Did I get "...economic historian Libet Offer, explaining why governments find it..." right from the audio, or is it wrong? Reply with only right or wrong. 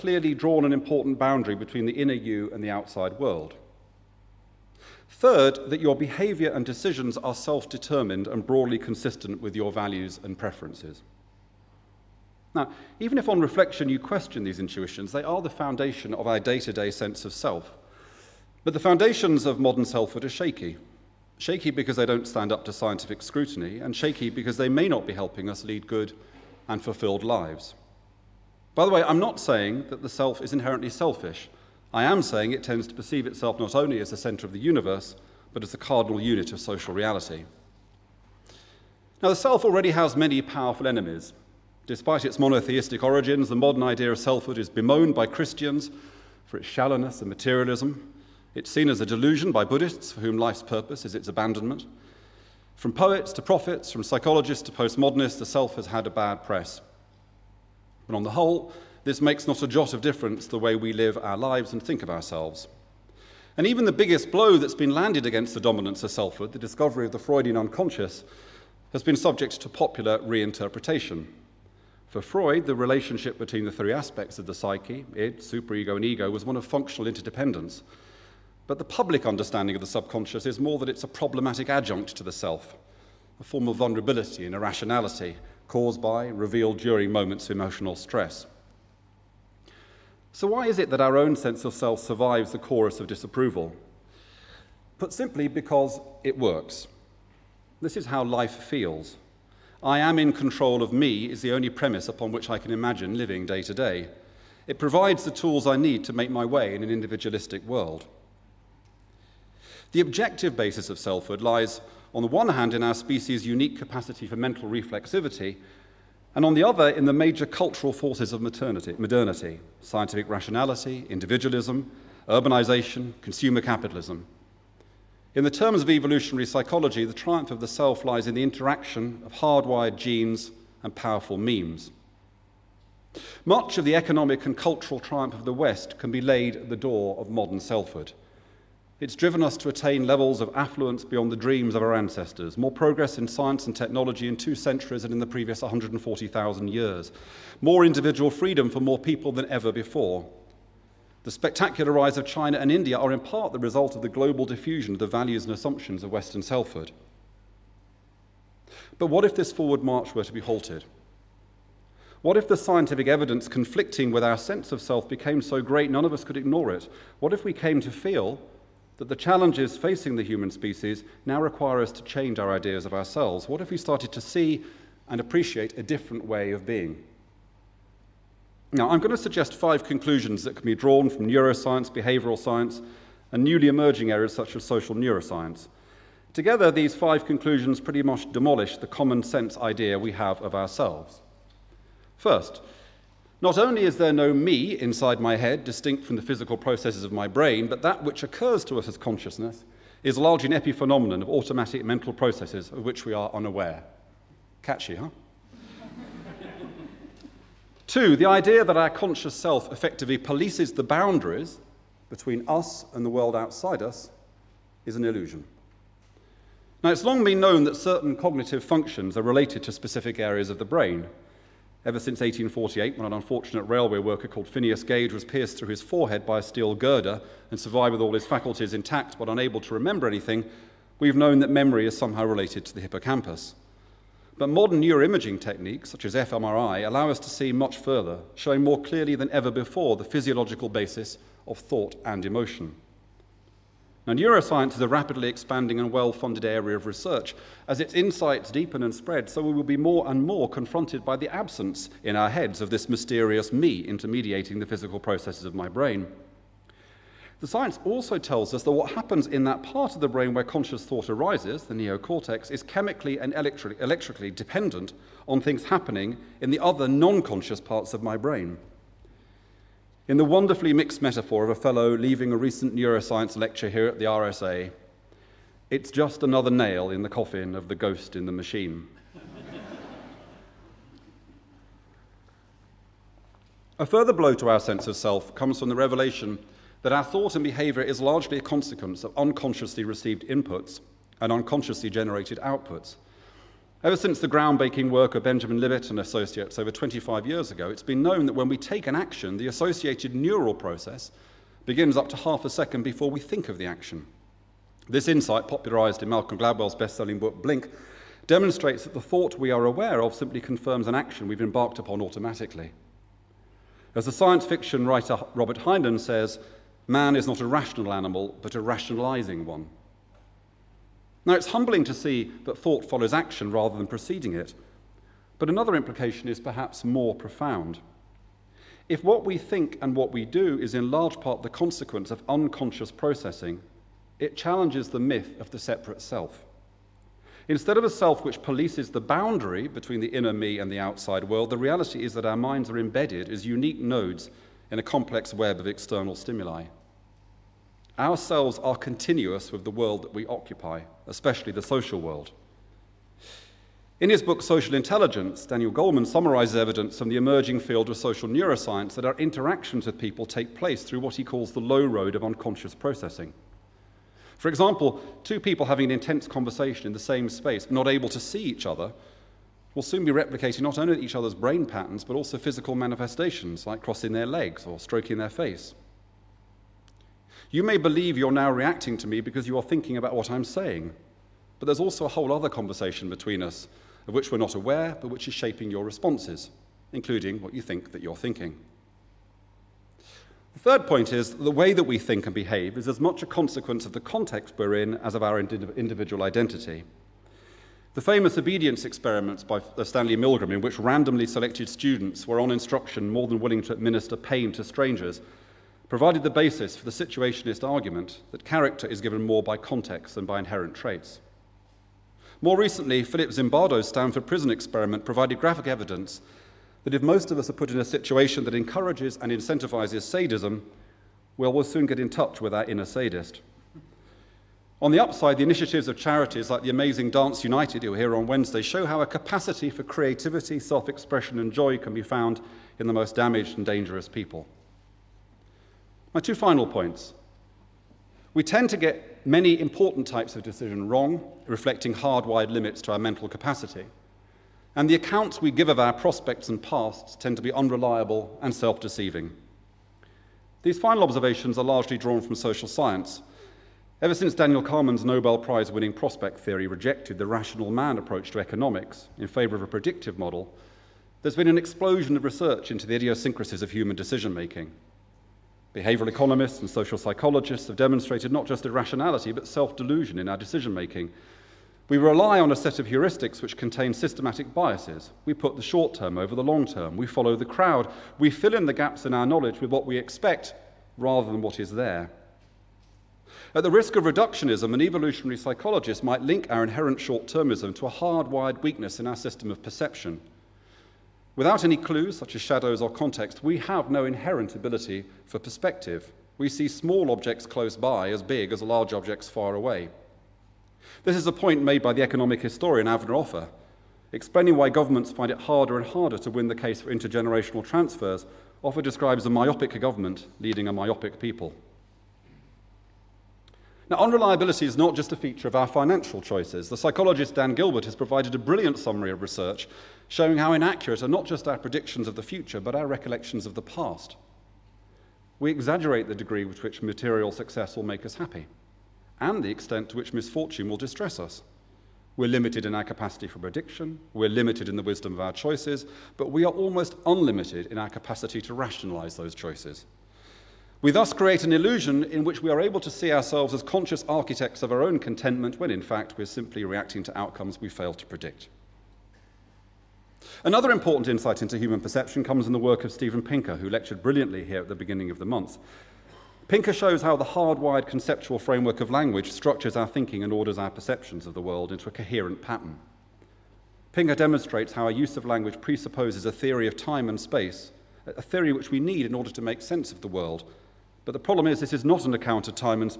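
wrong.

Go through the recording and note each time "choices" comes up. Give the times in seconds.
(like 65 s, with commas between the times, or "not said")
516 s, 535 s, 539 s.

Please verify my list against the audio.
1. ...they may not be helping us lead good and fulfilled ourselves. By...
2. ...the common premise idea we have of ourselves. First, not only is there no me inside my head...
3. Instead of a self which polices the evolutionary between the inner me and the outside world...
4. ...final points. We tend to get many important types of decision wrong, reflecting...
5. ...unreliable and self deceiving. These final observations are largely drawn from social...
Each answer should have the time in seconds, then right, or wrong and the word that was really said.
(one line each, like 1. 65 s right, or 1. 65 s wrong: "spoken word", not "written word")
1. 24 s wrong: "lives", not "ourselves"
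2. 188 s wrong: "sense", not "premise"
3. 337 s wrong: "boundary", not "evolutionary"
4. 436 s right
5. 447 s right.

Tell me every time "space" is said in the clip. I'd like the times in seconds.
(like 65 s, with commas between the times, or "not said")
367 s, 567 s.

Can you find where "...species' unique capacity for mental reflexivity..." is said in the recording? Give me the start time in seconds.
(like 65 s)
112 s.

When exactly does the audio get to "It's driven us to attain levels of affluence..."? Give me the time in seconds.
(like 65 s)
139 s.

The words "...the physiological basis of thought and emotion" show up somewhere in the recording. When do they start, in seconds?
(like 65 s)
239 s.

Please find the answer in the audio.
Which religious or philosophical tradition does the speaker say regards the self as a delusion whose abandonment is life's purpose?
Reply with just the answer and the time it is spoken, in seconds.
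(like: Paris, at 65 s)
Buddhists, at 49 s.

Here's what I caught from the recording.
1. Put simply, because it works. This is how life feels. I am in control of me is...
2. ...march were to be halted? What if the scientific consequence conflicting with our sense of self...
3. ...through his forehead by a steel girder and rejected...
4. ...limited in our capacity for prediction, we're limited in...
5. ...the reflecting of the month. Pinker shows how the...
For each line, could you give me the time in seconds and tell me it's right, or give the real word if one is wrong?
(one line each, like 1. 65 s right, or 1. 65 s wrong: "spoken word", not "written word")
1. 94 s right
2. 159 s wrong: "evidence", not "consequence"
3. 225 s wrong: "survived", not "rejected"
4. 532 s right
5. 554 s wrong: "beginning", not "reflecting".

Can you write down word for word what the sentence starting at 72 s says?
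For Freud, the relationship between the three aspects of the psyche, id, superego, and ego, was one of functional interdependence.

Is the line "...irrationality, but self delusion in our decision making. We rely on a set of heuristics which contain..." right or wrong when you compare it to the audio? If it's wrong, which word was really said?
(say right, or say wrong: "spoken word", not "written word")
right.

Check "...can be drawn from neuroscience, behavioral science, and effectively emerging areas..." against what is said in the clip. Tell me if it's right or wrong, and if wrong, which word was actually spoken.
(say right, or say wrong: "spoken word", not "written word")
wrong: "newly", not "effectively".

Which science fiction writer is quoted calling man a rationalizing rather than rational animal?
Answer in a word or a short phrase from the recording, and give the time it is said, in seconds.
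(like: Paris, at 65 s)
Robert Heinlein, at 315 s.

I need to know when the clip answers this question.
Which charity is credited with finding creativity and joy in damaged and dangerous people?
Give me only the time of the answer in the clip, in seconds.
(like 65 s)
427 s.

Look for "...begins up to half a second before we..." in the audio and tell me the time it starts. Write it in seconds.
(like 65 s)
301 s.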